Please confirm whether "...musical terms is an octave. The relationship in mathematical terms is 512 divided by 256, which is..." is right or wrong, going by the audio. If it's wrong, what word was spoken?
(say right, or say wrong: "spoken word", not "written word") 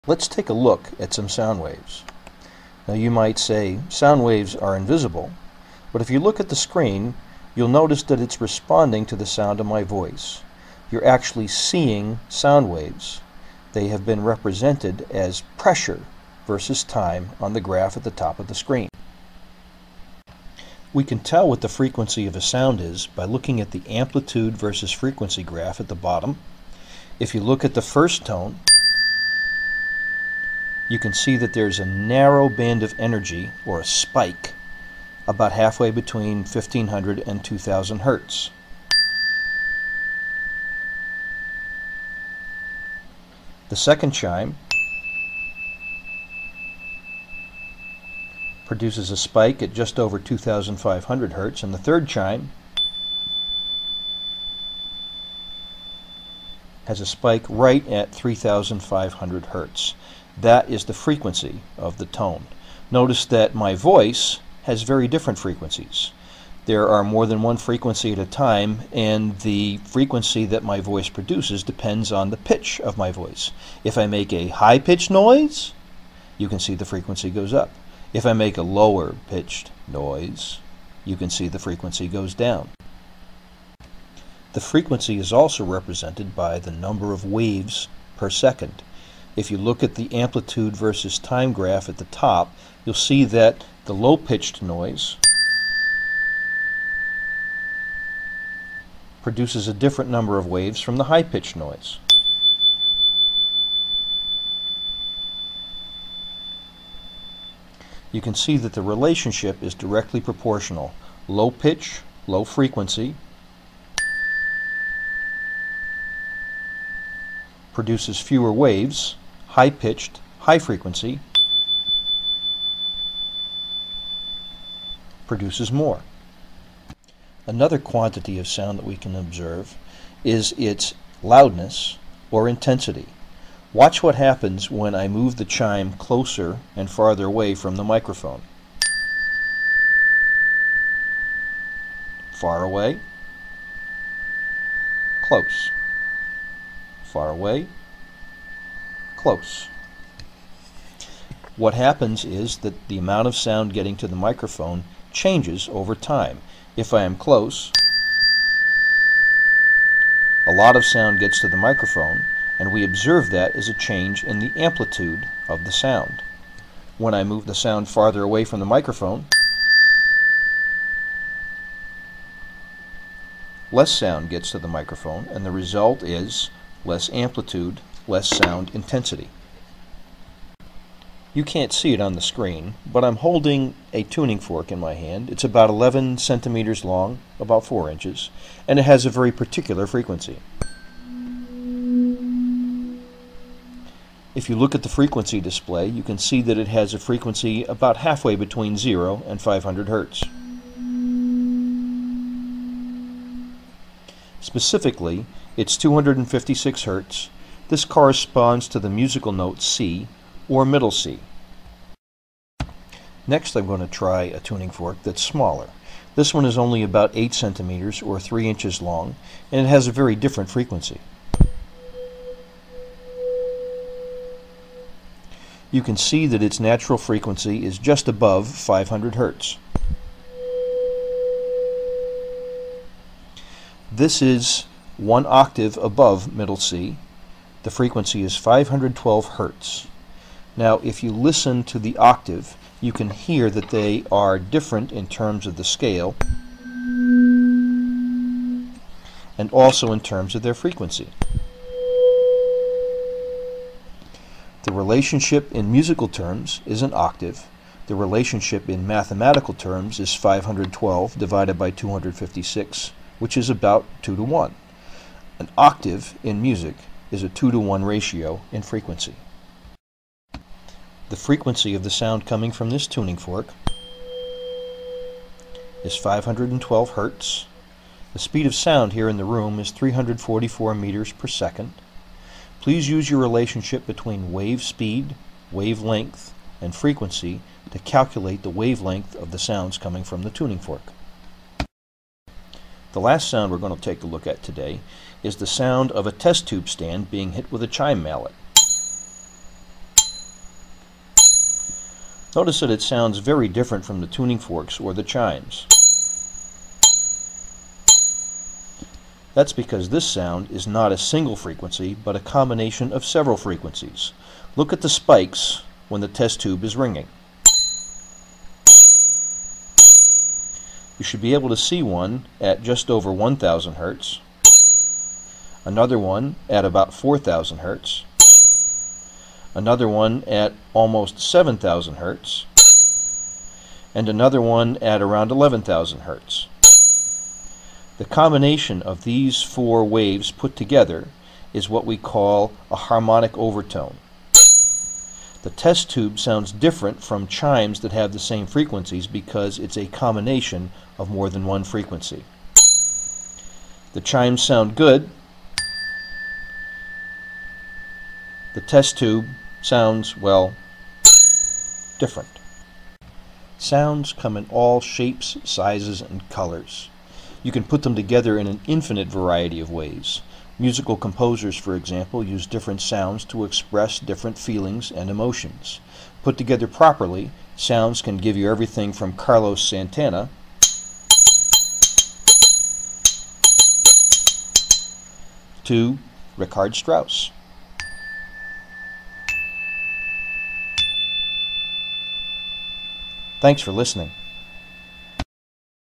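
right.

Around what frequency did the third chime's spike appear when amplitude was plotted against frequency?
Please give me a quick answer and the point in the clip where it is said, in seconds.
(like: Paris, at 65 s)
3500 hertz, at 58 s.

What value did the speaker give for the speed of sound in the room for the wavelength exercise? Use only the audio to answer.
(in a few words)
344 meters per second.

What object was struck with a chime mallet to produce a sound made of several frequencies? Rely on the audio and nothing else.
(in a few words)
test tube stand.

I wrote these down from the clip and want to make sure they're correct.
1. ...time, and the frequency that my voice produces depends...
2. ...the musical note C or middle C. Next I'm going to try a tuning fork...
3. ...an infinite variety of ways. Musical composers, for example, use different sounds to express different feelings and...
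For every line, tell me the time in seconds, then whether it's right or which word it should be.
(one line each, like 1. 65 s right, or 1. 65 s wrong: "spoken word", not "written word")
1. 68 s right
2. 208 s right
3. 368 s right.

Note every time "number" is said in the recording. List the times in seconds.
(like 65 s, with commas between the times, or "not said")
86 s, 100 s.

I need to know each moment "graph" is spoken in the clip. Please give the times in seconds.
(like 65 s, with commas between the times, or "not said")
17 s, 25 s, 91 s.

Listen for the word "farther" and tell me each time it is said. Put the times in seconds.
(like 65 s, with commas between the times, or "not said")
136 s, 167 s.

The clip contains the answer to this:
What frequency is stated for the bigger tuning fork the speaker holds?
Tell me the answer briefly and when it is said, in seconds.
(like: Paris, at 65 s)
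256 hertz, at 205 s.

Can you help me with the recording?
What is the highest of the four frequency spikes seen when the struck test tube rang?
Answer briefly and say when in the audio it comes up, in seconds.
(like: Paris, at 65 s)
11,000 hertz, at 335 s.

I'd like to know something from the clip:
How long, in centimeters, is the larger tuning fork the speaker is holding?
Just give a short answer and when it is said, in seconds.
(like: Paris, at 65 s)
11 centimeters, at 185 s.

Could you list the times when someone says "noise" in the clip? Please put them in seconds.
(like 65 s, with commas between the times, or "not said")
75 s, 79 s, 94 s, 101 s.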